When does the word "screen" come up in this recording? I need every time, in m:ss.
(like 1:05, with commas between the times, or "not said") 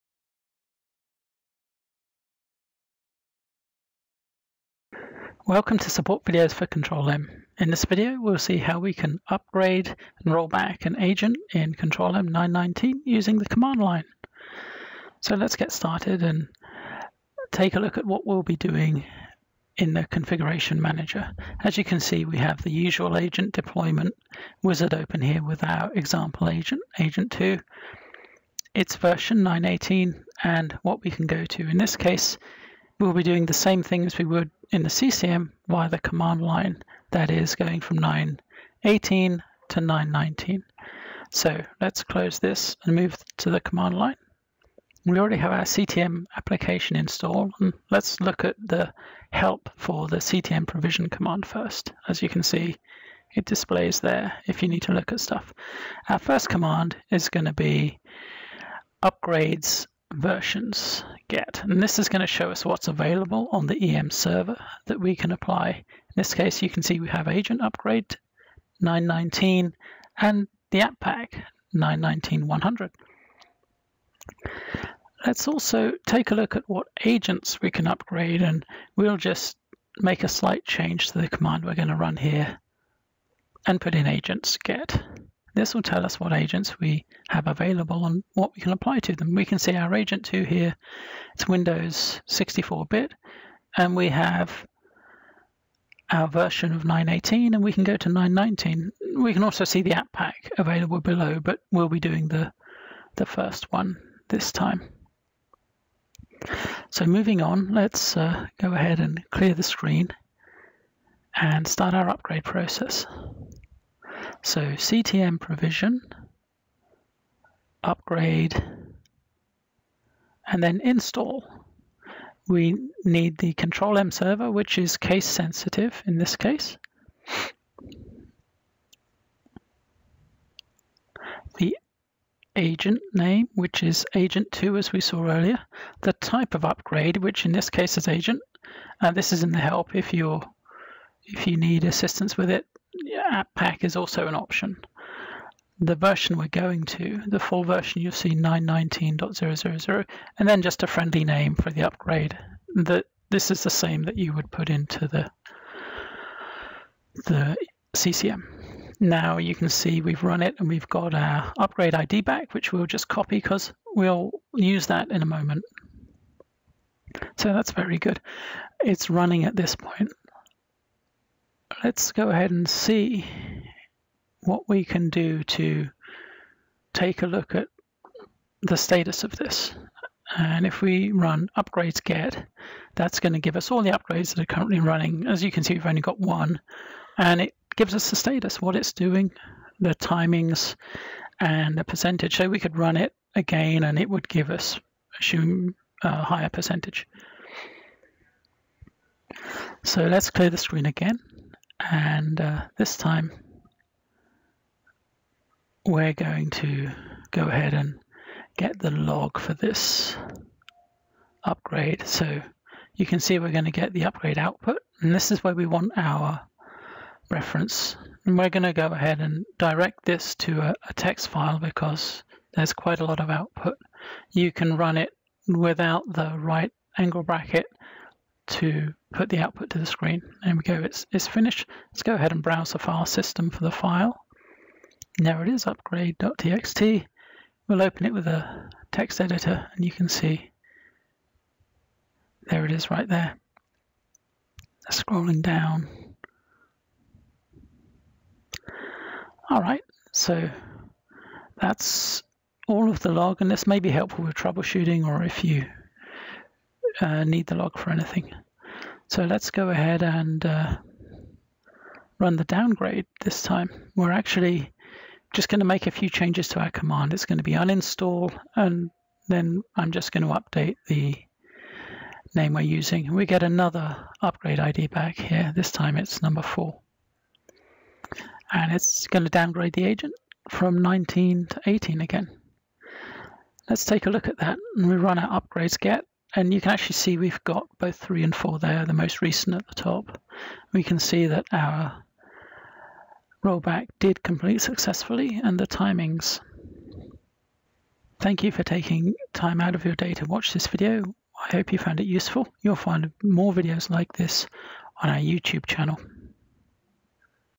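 1:49, 3:20, 3:49.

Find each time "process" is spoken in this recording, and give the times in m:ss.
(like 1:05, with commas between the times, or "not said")
1:52.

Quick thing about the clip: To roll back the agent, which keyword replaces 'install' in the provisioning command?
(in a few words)
uninstall.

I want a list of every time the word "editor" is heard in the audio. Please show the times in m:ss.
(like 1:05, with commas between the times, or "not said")
3:59.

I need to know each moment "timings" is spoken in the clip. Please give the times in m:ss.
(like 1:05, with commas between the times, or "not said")
3:09, 4:55.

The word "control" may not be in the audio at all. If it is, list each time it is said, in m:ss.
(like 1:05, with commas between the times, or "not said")
0:06, 0:11, 2:03.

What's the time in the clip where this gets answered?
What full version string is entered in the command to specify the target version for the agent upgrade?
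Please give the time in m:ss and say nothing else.
2:28.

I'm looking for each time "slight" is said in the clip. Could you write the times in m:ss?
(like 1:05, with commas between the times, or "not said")
1:20.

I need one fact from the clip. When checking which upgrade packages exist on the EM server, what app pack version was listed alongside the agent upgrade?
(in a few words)
919-100.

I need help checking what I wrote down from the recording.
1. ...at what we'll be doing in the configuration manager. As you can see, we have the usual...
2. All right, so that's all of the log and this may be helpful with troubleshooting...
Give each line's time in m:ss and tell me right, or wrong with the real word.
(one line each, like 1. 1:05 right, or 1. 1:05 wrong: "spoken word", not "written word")
1. 0:17 right
2. 4:09 right.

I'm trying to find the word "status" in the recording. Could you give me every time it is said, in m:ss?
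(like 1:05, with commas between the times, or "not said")
2:58, 3:08.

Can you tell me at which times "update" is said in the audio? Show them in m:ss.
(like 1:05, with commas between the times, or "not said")
4:30.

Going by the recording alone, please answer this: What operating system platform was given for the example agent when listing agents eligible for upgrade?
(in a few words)
Windows 64-bit.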